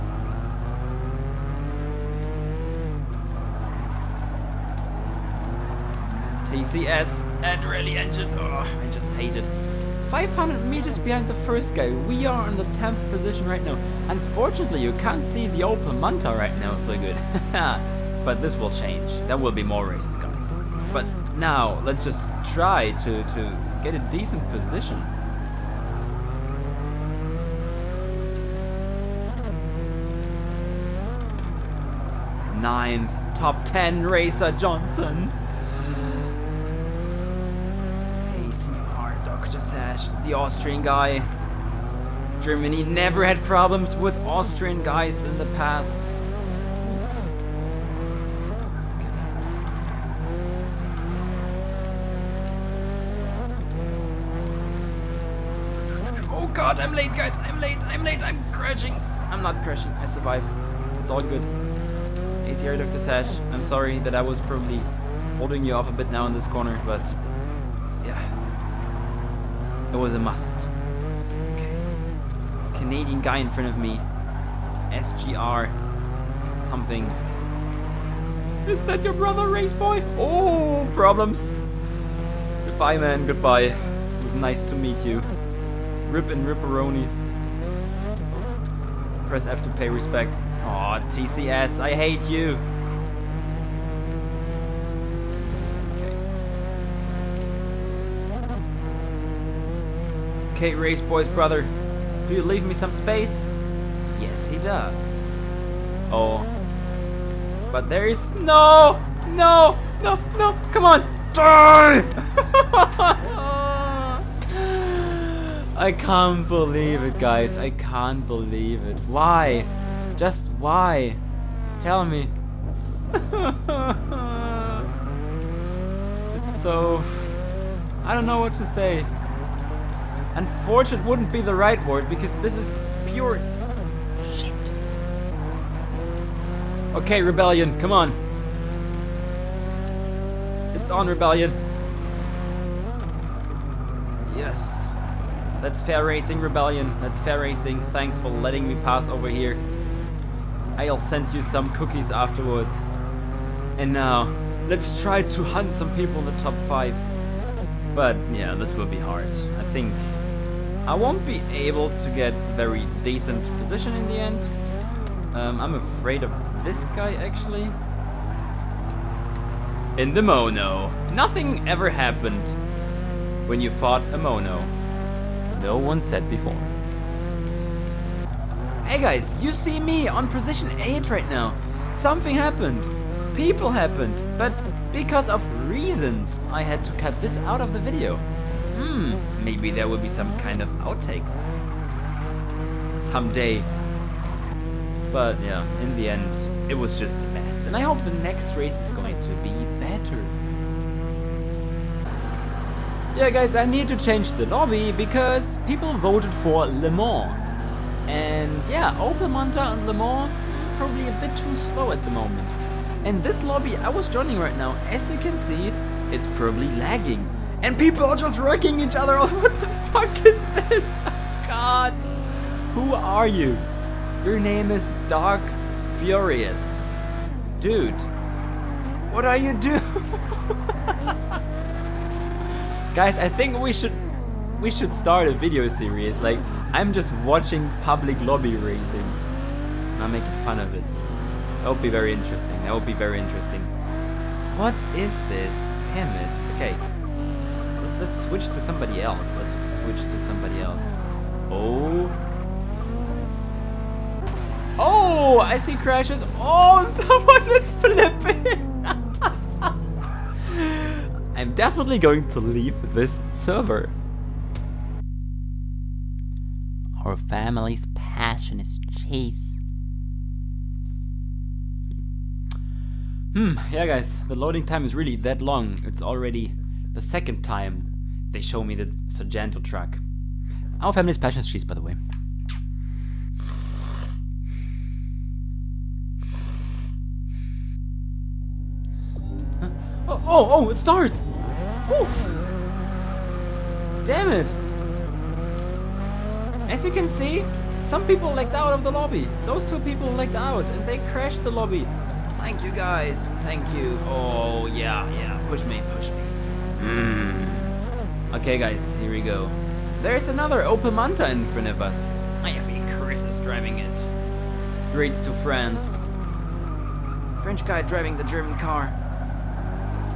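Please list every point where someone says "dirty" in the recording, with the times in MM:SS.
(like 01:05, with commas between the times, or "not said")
not said.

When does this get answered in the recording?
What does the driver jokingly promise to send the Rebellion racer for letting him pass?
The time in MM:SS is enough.
02:31.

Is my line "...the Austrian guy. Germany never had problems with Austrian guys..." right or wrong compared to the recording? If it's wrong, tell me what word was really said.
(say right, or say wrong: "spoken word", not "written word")
right.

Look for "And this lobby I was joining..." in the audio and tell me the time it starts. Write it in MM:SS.
03:33.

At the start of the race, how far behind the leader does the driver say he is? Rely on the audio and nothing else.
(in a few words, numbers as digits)
500 meters.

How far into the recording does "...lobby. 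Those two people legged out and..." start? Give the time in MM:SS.
04:58.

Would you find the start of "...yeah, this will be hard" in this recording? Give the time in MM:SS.
02:38.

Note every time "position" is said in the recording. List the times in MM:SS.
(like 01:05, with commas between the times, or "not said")
00:13, 00:24, 02:43, 03:00.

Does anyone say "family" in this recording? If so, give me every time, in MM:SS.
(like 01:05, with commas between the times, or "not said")
04:27, 04:40.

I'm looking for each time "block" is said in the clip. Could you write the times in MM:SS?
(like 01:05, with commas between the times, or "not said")
not said.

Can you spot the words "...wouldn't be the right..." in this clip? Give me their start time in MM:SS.
02:11.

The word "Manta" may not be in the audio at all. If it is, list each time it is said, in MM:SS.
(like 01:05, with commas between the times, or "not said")
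00:15, 03:29, 05:10.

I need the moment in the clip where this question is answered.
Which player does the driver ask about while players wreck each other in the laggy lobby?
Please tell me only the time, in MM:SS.
03:45.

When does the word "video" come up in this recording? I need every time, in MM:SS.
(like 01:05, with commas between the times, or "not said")
03:07, 03:55.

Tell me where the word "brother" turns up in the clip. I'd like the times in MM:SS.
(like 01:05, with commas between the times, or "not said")
01:19, 01:41.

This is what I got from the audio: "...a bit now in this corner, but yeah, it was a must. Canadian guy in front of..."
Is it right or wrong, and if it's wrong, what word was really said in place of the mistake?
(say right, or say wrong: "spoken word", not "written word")
right.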